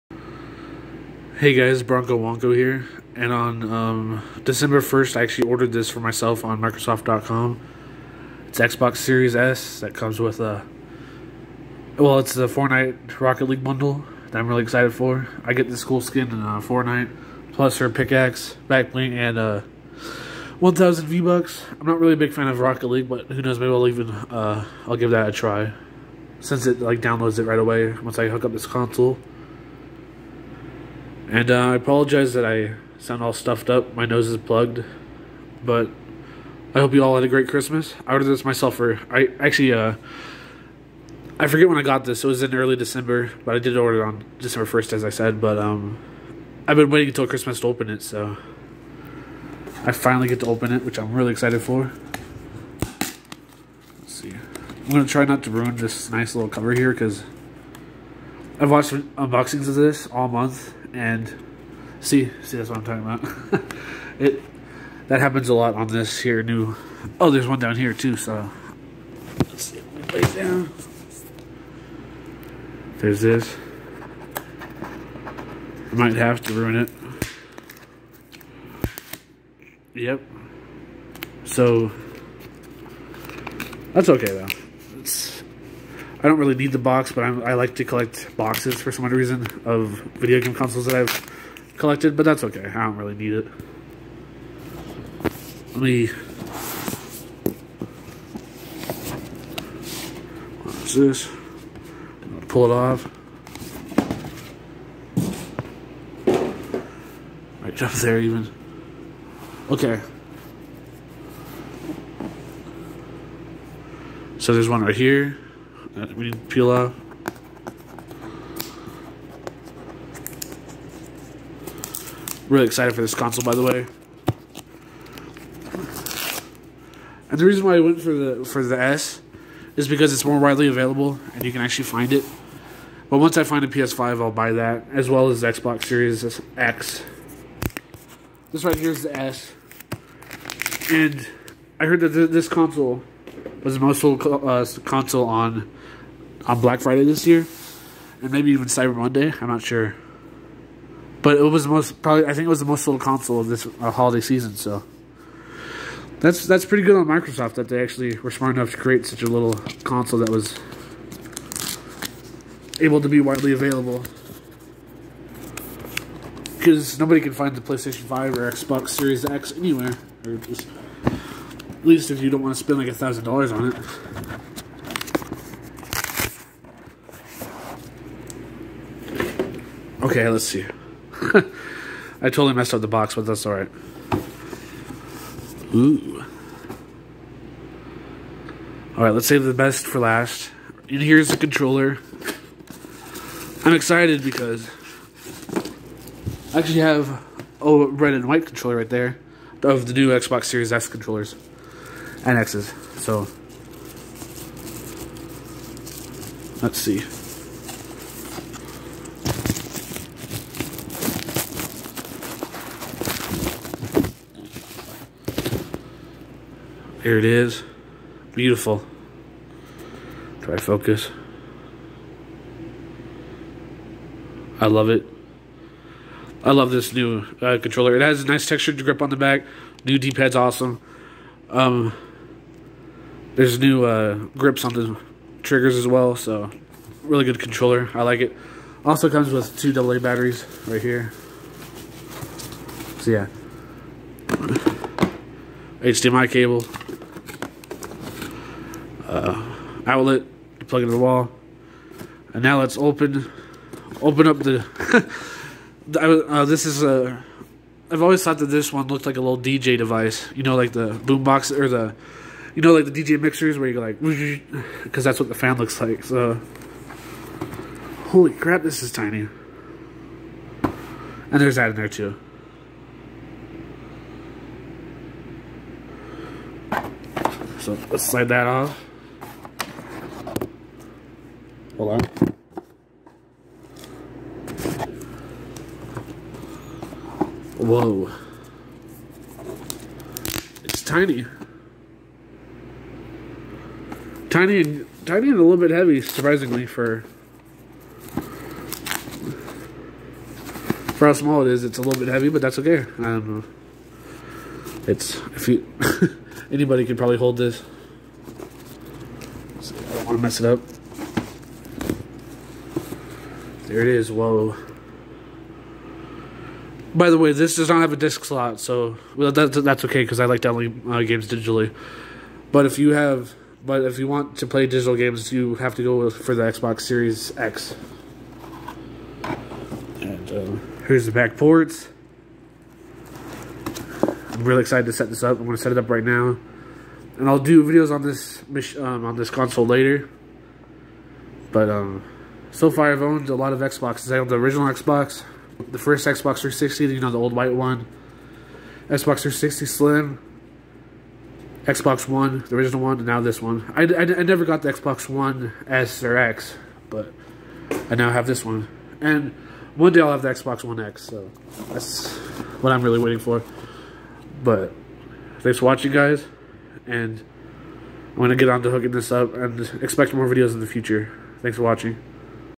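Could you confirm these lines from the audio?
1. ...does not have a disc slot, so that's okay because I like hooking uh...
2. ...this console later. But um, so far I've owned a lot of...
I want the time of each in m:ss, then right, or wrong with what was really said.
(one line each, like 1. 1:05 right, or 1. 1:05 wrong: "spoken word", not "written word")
1. 5:17 wrong: "downloading", not "hooking"
2. 5:39 right.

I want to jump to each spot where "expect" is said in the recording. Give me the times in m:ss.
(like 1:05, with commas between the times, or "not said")
6:09.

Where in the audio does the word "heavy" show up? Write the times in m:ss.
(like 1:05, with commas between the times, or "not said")
4:55, 5:02.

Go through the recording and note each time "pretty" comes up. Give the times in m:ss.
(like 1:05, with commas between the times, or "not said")
2:36.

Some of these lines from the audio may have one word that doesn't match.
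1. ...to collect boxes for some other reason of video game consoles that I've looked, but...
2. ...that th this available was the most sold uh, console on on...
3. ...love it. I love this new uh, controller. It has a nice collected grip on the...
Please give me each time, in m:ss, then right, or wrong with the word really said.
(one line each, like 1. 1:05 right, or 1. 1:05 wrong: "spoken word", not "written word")
1. 1:27 wrong: "collected", not "looked"
2. 2:22 wrong: "console", not "available"
3. 3:44 wrong: "textured", not "collected".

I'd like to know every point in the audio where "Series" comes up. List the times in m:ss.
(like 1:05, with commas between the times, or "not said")
0:08, 2:15, 2:48, 3:20, 5:26.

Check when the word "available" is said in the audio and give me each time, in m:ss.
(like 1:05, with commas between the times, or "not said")
2:10, 2:43.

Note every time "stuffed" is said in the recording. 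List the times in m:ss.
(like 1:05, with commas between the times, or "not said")
0:33.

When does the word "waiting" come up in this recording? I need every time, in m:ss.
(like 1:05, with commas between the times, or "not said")
0:46, 6:02.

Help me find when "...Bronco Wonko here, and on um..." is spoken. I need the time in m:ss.
0:01.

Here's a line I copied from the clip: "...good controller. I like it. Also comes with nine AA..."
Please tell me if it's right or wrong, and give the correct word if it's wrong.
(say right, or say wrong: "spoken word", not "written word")
wrong: "two", not "nine".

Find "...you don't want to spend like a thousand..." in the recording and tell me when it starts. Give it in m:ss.
2:52.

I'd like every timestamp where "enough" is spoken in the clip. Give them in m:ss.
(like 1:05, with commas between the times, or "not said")
2:38.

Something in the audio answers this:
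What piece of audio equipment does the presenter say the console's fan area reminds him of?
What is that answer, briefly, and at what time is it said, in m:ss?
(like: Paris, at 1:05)
DJ mixers, at 4:23.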